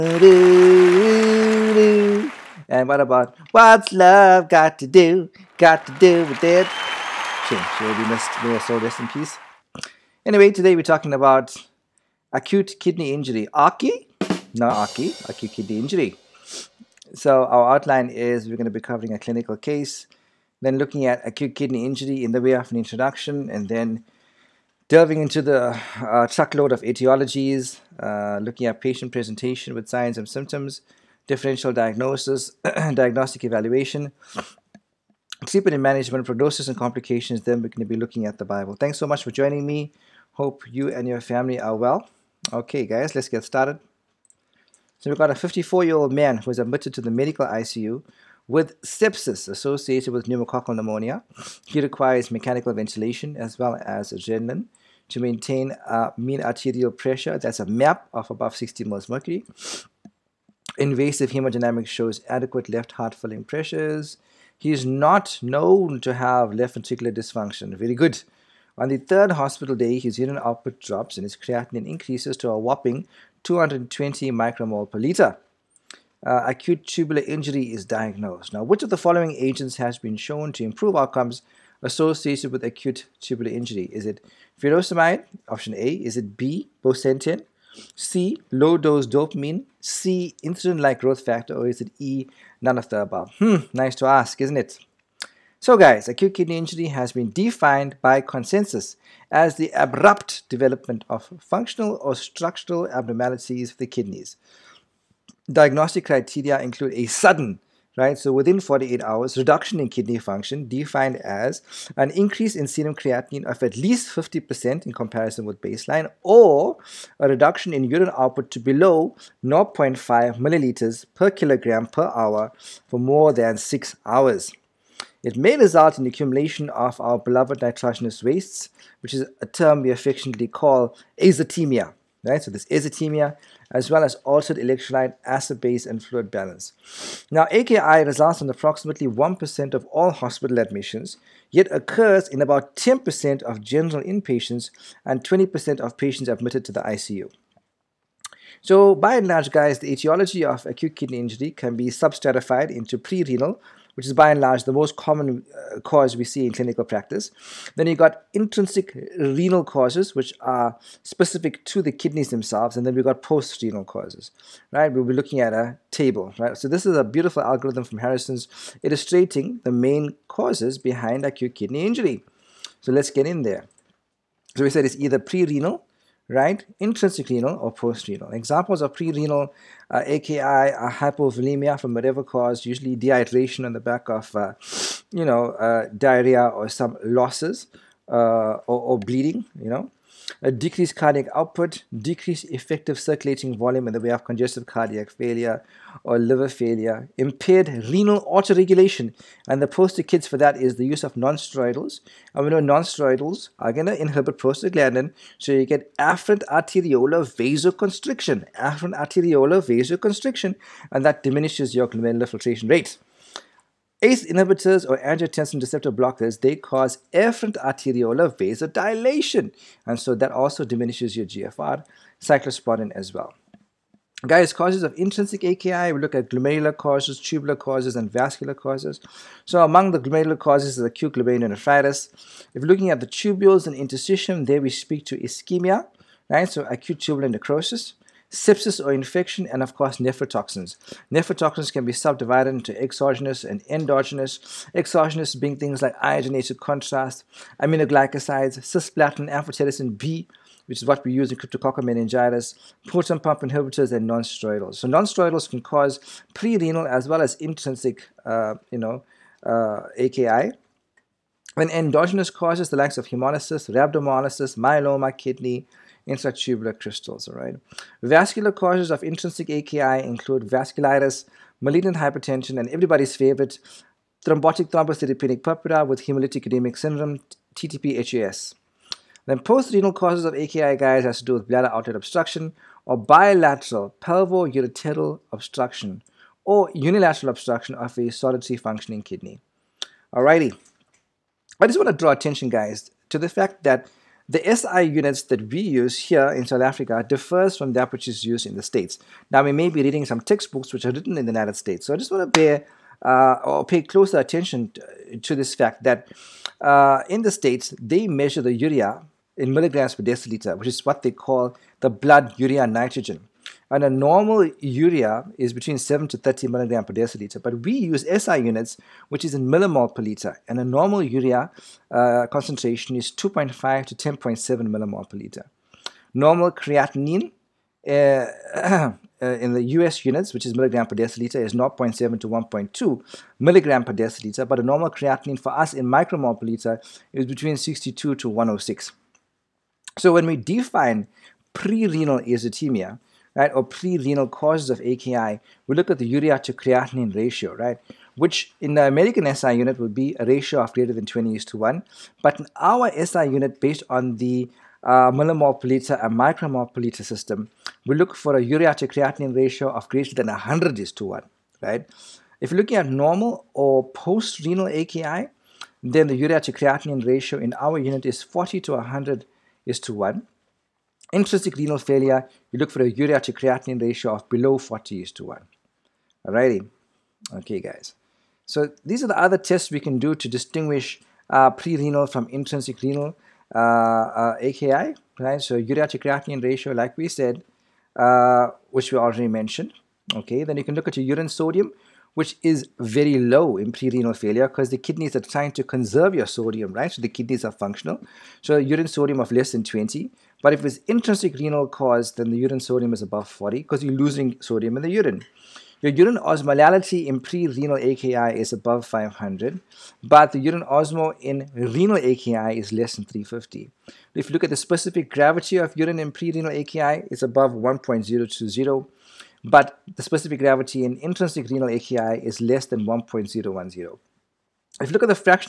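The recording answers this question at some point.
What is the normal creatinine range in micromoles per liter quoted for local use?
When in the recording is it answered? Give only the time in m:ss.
5:37.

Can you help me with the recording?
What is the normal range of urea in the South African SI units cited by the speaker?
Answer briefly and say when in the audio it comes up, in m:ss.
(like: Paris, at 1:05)
2.5 to 10.7 mmol/L, at 5:23.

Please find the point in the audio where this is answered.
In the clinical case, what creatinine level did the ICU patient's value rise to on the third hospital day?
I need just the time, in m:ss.
1:13.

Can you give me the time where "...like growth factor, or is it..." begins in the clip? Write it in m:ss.
1:30.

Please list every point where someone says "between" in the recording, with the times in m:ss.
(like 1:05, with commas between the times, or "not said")
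5:15, 5:37.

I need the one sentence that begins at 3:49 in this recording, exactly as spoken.
So among the glomerular causes is acute glomerulonephritis.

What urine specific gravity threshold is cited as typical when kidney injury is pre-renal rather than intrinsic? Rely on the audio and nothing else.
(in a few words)
above 1.020.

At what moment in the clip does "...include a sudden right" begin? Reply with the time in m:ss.
1:46.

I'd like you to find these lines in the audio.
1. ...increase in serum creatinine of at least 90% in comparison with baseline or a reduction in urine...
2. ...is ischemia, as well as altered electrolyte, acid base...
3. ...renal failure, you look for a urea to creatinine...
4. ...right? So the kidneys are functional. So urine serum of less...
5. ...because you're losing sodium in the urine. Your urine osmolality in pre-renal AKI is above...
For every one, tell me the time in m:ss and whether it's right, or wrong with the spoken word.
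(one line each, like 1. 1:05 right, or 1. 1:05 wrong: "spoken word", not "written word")
1. 1:52 wrong: "50", not "90"
2. 2:12 wrong: "atemia", not "ischemia"
3. 6:11 right
4. 6:36 wrong: "sodium", not "serum"
5. 6:43 right.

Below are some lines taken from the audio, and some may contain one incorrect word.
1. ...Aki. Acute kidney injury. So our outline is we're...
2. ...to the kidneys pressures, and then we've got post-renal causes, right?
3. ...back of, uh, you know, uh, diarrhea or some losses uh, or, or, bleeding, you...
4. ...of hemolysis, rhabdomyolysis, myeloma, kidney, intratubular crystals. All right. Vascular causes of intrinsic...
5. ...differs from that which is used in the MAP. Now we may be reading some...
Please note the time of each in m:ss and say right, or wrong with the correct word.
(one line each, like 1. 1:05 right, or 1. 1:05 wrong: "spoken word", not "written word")
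1. 0:14 right
2. 2:41 wrong: "themselves", not "pressures"
3. 3:03 right
4. 4:22 right
5. 4:57 wrong: "States", not "MAP".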